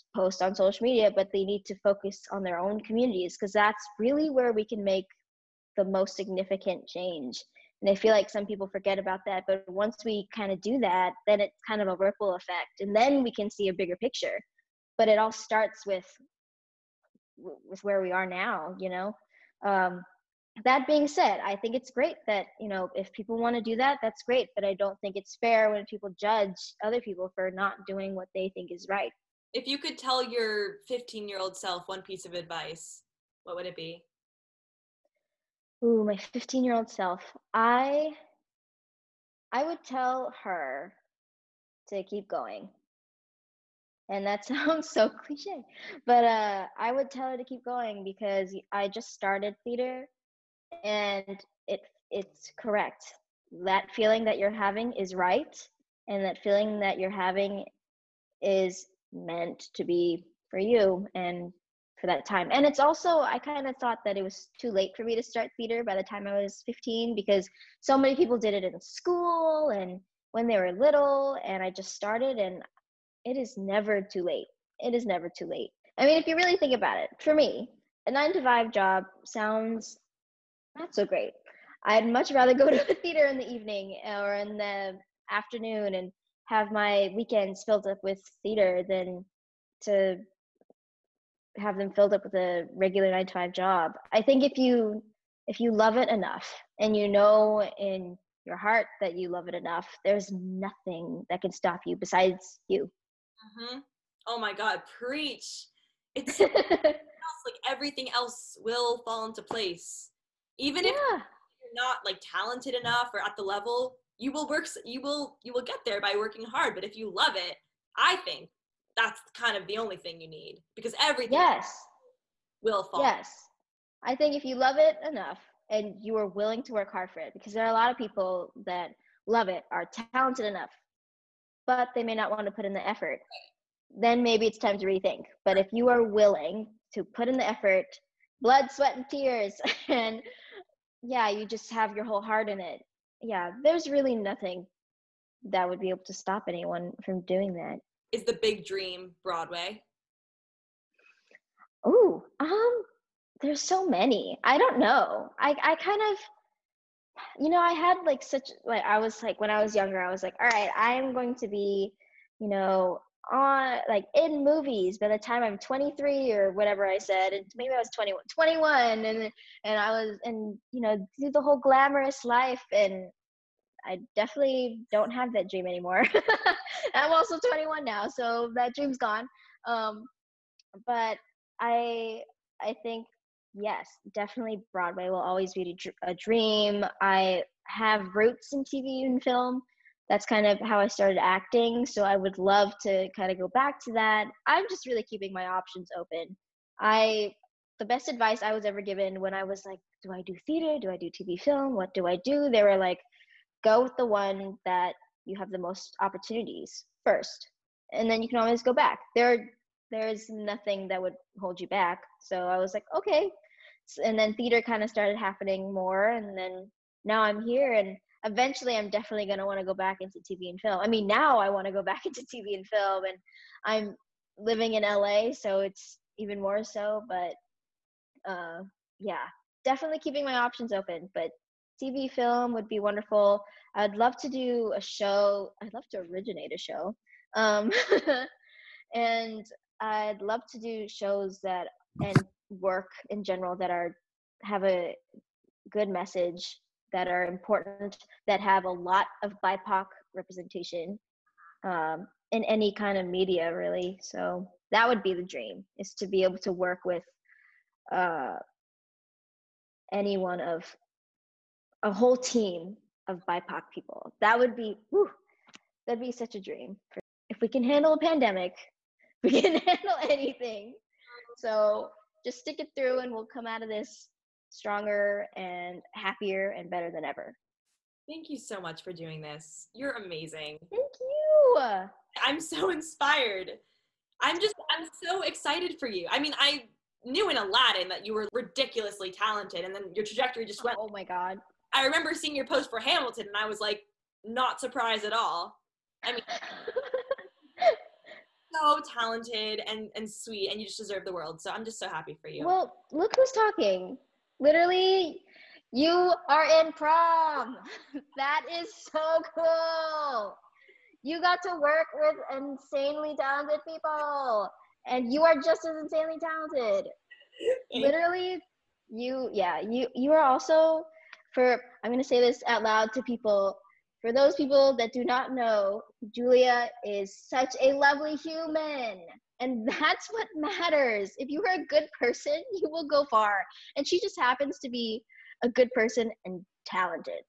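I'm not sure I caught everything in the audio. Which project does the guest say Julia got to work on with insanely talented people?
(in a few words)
Prom.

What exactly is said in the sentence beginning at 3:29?
There there's nothing that would hold you back.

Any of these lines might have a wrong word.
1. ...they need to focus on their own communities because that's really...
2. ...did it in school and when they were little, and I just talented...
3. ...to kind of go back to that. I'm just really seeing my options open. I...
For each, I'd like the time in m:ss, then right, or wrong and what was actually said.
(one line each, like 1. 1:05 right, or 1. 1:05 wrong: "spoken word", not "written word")
1. 0:01 right
2. 1:08 wrong: "started", not "talented"
3. 3:12 wrong: "keeping", not "seeing".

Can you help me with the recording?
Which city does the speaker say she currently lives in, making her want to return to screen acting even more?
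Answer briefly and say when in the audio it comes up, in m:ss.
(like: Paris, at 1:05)
LA, at 3:43.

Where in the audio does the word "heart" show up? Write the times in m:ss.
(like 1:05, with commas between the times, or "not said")
1:38, 2:22.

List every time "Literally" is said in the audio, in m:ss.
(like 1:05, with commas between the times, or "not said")
5:04, 5:17.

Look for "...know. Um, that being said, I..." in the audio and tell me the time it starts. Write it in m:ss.
0:18.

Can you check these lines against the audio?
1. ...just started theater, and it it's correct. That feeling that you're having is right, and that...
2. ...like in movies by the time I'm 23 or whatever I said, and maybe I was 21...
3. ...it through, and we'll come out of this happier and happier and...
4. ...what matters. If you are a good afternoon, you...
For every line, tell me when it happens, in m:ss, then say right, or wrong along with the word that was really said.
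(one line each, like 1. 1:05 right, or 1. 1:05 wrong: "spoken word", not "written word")
1. 0:48 right
2. 2:43 right
3. 4:32 wrong: "stronger", not "happier"
4. 5:30 wrong: "person", not "afternoon".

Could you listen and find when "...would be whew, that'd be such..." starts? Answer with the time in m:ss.
4:24.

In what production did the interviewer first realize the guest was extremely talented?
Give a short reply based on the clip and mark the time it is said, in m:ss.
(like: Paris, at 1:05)
Aladdin, at 4:47.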